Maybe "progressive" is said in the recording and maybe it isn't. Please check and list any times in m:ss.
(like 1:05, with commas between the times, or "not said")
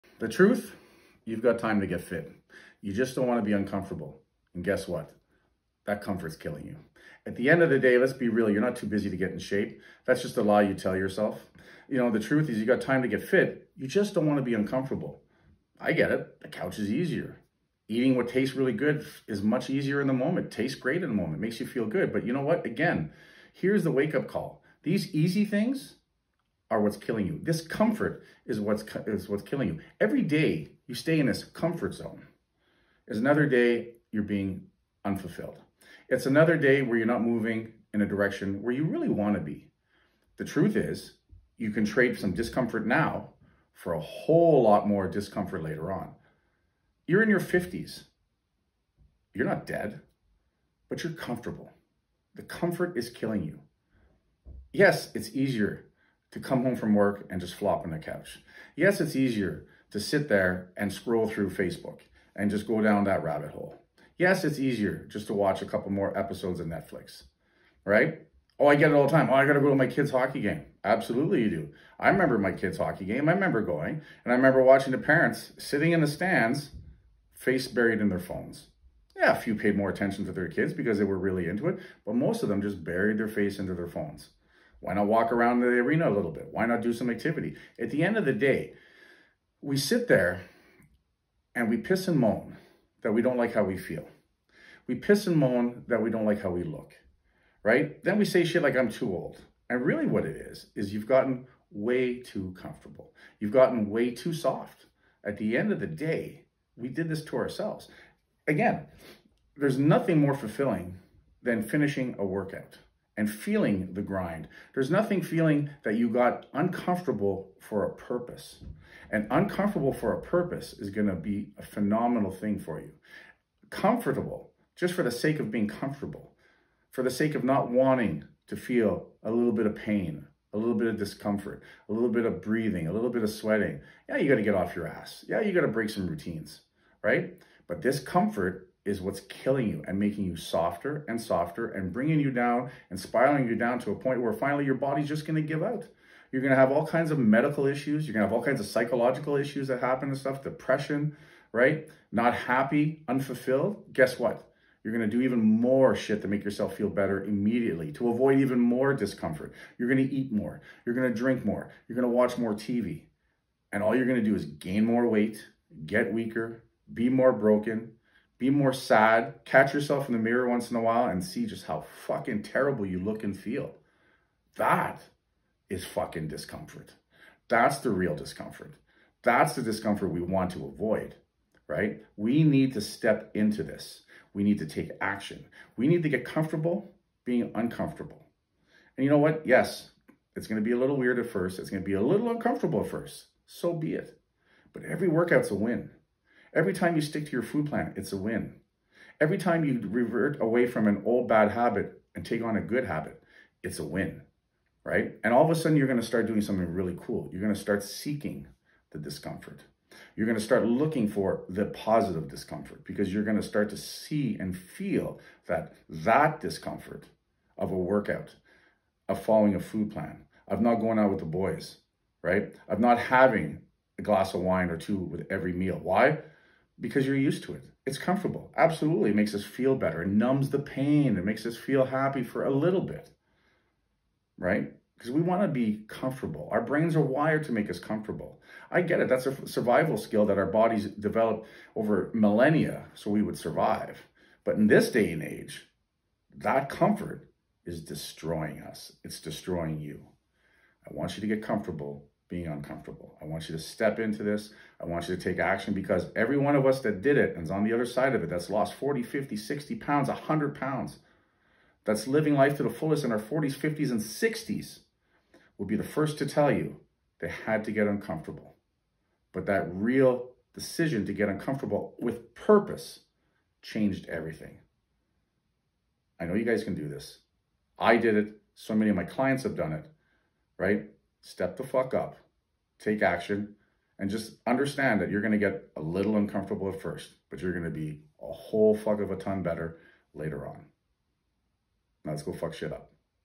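not said.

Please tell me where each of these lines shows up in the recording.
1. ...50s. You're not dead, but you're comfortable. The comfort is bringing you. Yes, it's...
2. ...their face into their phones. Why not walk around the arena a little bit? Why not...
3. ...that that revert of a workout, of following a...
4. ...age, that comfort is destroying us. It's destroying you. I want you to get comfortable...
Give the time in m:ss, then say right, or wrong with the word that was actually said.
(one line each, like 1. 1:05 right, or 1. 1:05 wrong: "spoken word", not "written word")
1. 0:47 wrong: "killing", not "bringing"
2. 1:23 right
3. 3:35 wrong: "discomfort", not "revert"
4. 4:05 right.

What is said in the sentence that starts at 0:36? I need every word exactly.
It's another day where you're not moving in a direction where you really want to be.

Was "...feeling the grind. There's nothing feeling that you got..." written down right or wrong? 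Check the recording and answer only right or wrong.
right.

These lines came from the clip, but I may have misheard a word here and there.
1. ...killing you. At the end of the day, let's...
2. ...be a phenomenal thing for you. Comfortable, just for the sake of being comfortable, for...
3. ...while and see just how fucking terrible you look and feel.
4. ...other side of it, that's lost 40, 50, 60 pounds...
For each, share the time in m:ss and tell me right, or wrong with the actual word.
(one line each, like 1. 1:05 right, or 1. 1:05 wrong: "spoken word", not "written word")
1. 0:06 right
2. 2:01 right
3. 2:50 right
4. 4:17 right.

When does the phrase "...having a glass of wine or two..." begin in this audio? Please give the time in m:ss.
3:42.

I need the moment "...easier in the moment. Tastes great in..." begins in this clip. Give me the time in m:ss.
0:19.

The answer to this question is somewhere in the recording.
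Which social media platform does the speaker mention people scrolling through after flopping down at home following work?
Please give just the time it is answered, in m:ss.
1:01.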